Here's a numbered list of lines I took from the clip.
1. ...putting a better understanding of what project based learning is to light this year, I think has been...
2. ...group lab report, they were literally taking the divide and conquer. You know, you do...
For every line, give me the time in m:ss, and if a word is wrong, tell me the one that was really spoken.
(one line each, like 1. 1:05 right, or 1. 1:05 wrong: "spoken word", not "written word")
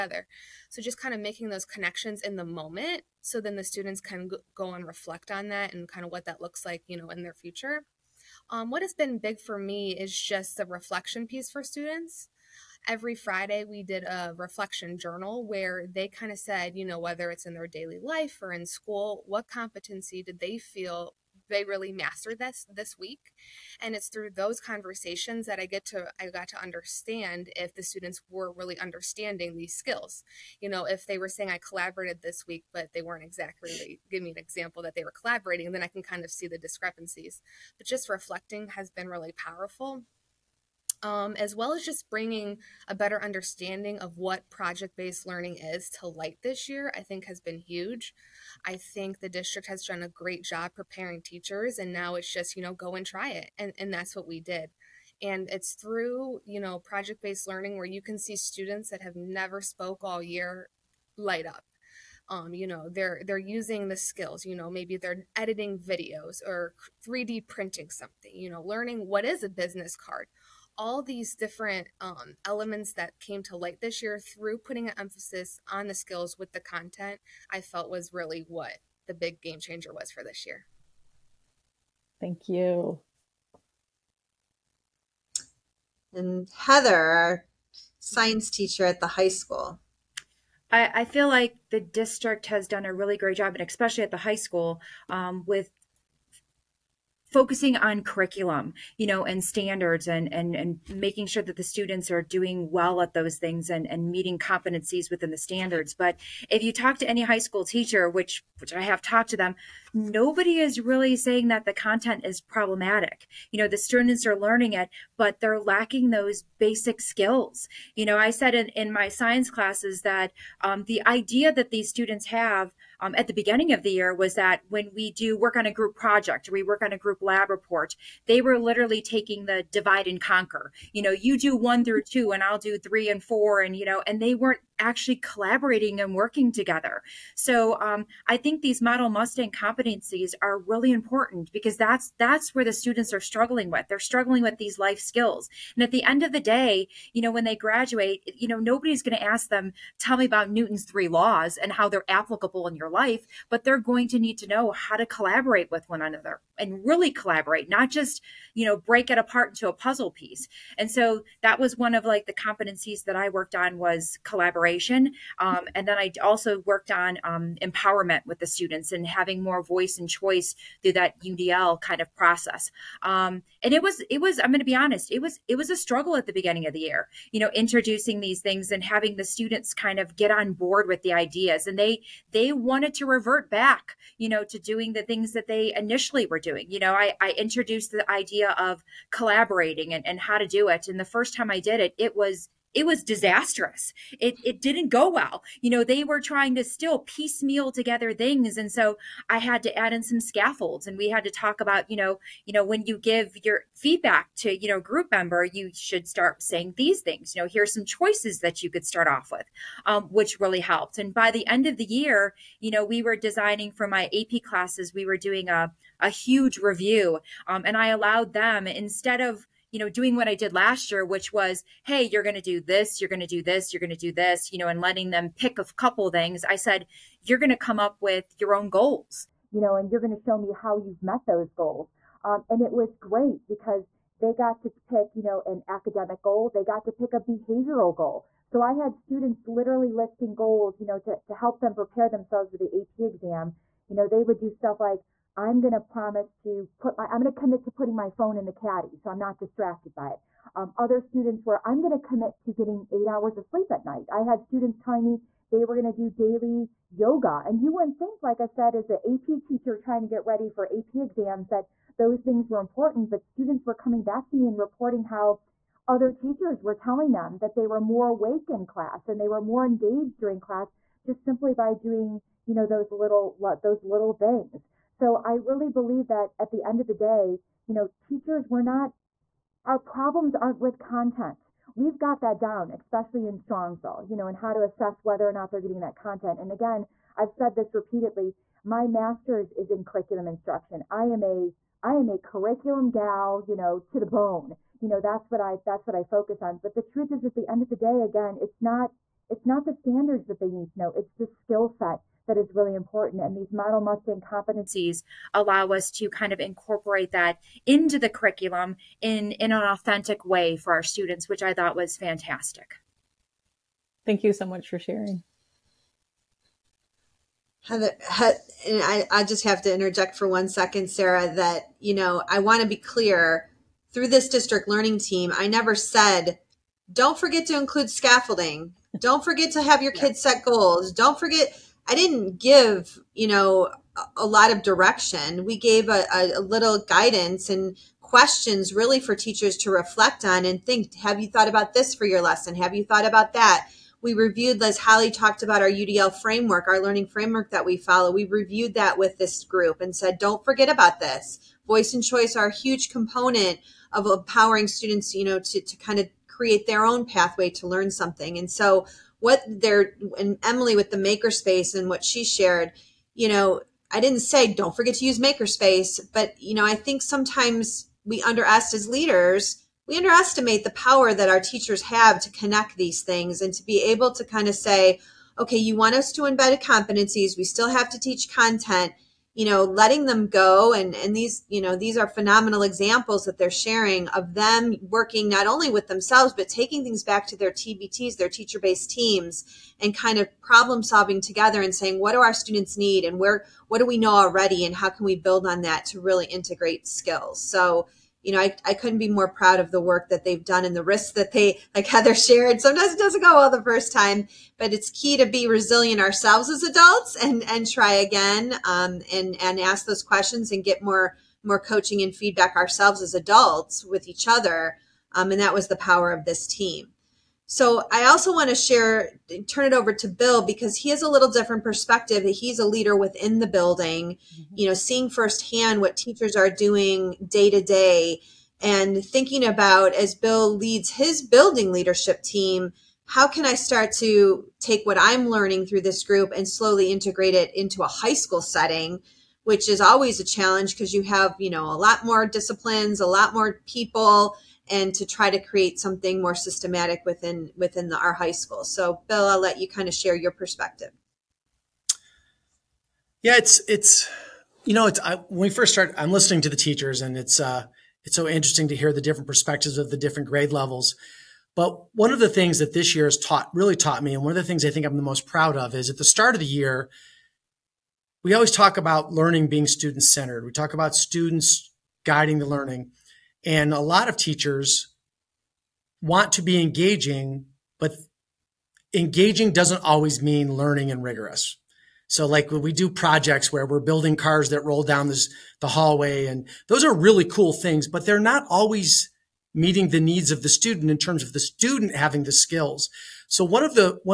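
1. 0:42 wrong: "bringing", not "putting"
2. 2:06 right.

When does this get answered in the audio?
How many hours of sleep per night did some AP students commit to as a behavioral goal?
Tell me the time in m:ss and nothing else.
4:12.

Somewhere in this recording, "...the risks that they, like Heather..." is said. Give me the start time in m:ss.
6:40.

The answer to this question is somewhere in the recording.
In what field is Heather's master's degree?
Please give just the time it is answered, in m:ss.
4:49.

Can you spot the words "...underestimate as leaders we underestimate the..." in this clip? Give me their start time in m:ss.
6:08.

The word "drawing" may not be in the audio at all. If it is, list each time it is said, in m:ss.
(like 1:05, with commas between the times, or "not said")
not said.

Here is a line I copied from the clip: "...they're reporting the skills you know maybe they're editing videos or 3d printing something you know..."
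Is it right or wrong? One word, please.
wrong.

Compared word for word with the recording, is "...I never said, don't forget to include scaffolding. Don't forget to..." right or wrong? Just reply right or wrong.
right.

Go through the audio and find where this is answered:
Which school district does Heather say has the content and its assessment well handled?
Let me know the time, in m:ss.
4:43.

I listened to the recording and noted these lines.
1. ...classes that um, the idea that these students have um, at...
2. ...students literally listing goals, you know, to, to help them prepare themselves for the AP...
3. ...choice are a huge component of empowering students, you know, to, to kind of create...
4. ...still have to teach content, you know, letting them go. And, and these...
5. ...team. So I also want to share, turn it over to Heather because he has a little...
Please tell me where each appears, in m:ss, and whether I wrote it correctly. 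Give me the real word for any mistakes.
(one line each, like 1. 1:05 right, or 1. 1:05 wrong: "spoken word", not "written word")
1. 1:59 right
2. 3:58 right
3. 5:52 right
4. 6:17 right
5. 6:56 wrong: "Bill", not "Heather".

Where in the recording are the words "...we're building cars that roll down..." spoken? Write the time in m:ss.
8:03.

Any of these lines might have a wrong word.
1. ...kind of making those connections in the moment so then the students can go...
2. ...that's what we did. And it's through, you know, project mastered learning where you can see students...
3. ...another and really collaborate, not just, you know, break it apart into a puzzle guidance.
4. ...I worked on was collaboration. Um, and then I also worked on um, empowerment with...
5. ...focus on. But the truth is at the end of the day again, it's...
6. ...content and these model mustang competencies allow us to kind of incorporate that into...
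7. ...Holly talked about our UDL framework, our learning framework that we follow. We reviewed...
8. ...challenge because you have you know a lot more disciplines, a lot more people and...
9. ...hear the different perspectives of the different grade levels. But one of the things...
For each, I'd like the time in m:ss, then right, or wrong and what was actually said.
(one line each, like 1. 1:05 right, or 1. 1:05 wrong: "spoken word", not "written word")
1. 0:00 right
2. 0:53 wrong: "based", not "mastered"
3. 2:36 wrong: "piece", not "guidance"
4. 2:43 right
5. 4:56 right
6. 5:02 wrong: "important", not "content"
7. 5:44 right
8. 7:20 right
9. 7:38 right.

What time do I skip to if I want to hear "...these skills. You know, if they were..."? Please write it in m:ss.
0:29.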